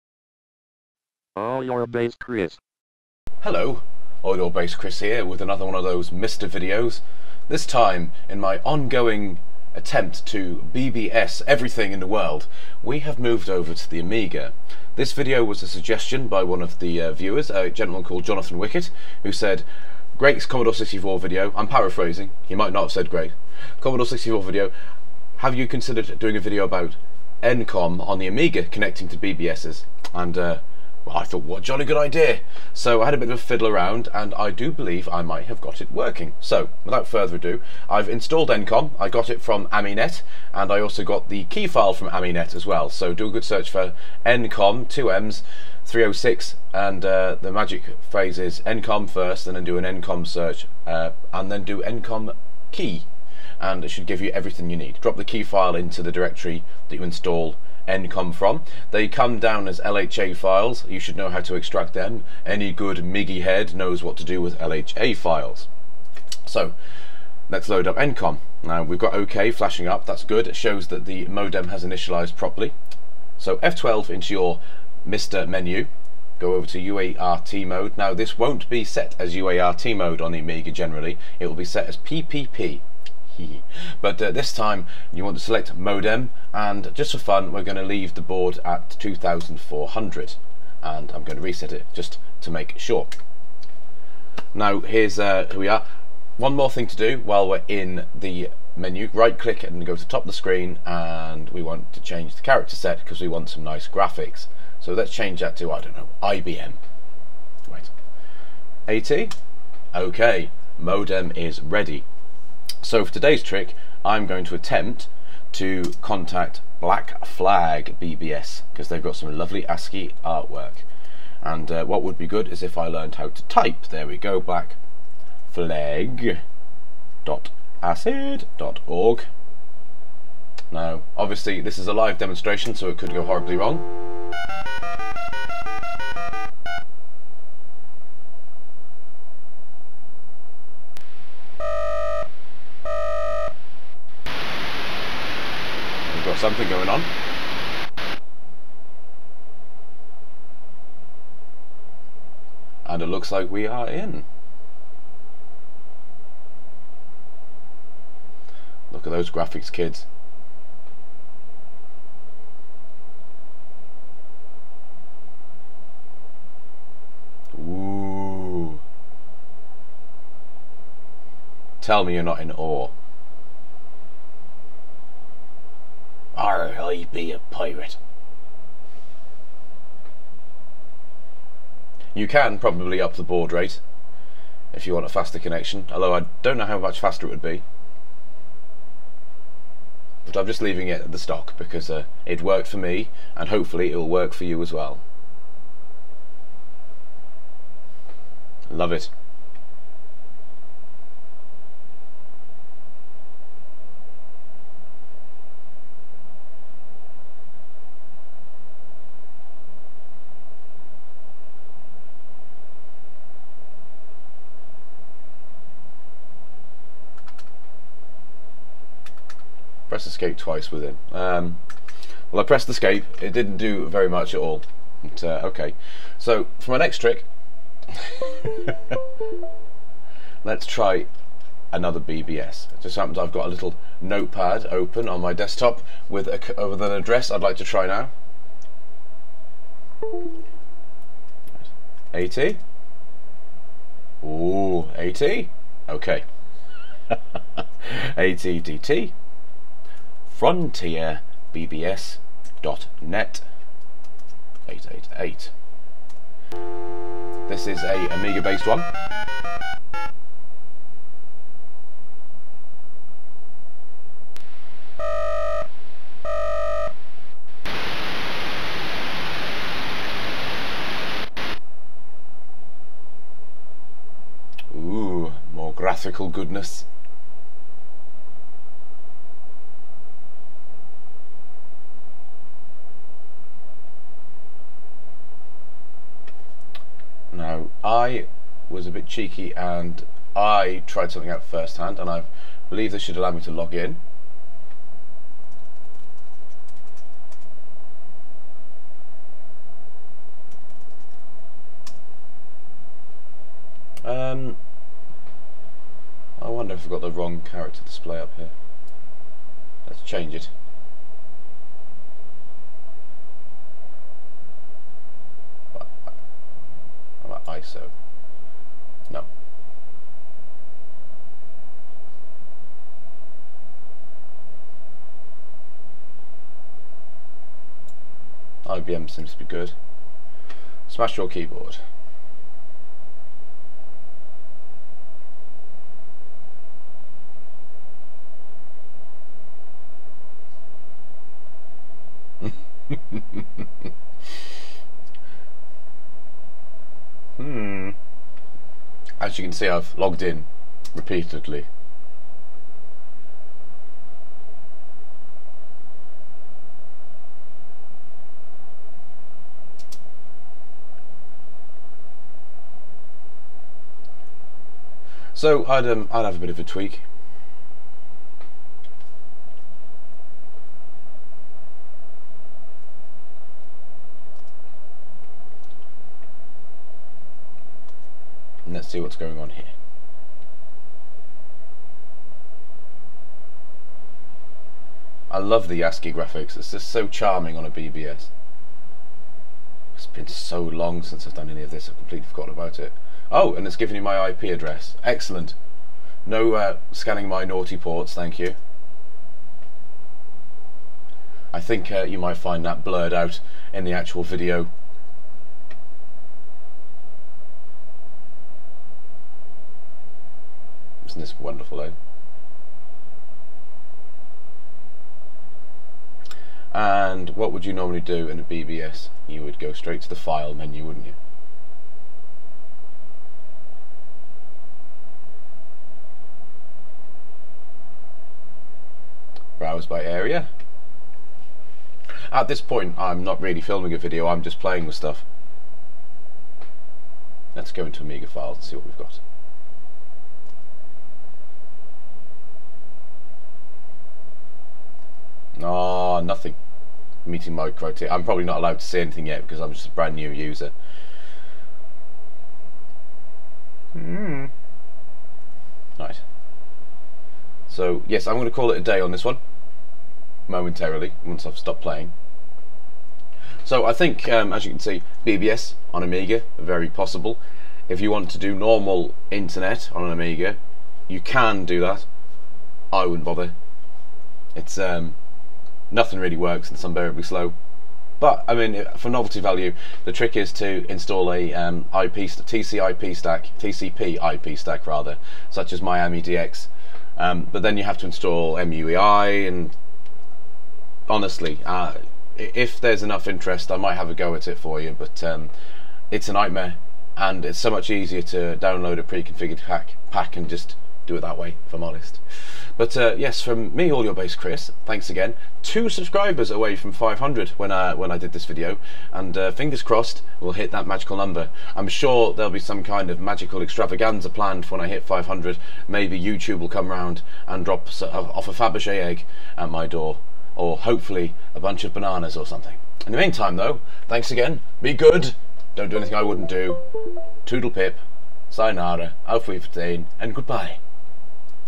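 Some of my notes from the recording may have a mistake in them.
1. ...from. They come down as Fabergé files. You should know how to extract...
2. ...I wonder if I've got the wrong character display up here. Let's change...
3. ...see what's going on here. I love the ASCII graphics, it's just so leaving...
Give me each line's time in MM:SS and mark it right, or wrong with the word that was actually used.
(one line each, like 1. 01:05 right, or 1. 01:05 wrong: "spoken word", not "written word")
1. 00:58 wrong: "LHA", not "Fabergé"
2. 05:06 right
3. 06:18 wrong: "charming", not "leaving".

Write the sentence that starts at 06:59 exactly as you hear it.
You would go straight to the file menu, wouldn't you?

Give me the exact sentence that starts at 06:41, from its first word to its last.
I think uh, you might find that blurred out in the actual video in this wonderful loan.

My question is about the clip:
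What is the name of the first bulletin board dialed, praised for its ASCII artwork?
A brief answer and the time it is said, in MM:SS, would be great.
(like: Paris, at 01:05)
Black Flag BBS, at 01:56.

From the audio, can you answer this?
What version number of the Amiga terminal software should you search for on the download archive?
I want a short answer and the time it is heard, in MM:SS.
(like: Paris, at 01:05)
306, at 00:45.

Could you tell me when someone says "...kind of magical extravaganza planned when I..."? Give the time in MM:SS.
08:32.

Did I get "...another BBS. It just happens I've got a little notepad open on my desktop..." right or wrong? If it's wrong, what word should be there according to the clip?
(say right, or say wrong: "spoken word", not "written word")
right.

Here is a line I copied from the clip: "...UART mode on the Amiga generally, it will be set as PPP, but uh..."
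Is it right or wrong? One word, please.
right.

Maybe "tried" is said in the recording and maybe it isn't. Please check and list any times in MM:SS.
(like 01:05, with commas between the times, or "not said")
04:50.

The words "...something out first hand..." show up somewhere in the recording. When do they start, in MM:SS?
04:51.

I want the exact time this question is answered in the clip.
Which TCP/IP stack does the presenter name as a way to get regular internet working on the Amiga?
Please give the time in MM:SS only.
08:05.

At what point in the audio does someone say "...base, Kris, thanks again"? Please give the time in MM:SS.
08:24.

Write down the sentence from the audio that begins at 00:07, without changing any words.
This time, in my ongoing attempt to BBS everything in the world, we have moved over to the Amiga.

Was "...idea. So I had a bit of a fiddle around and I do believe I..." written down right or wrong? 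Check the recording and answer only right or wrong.
right.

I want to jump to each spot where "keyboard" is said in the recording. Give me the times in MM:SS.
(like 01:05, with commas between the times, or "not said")
05:31.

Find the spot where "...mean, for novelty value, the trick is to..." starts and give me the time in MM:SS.
07:58.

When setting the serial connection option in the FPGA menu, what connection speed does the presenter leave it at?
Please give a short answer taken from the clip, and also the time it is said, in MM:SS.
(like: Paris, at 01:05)
2400, at 01:28.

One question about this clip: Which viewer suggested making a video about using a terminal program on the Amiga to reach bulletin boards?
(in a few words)
Johnathan Wickett.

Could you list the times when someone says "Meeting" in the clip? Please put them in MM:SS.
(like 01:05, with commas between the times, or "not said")
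07:27.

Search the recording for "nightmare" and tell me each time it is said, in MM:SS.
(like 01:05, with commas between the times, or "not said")
08:16.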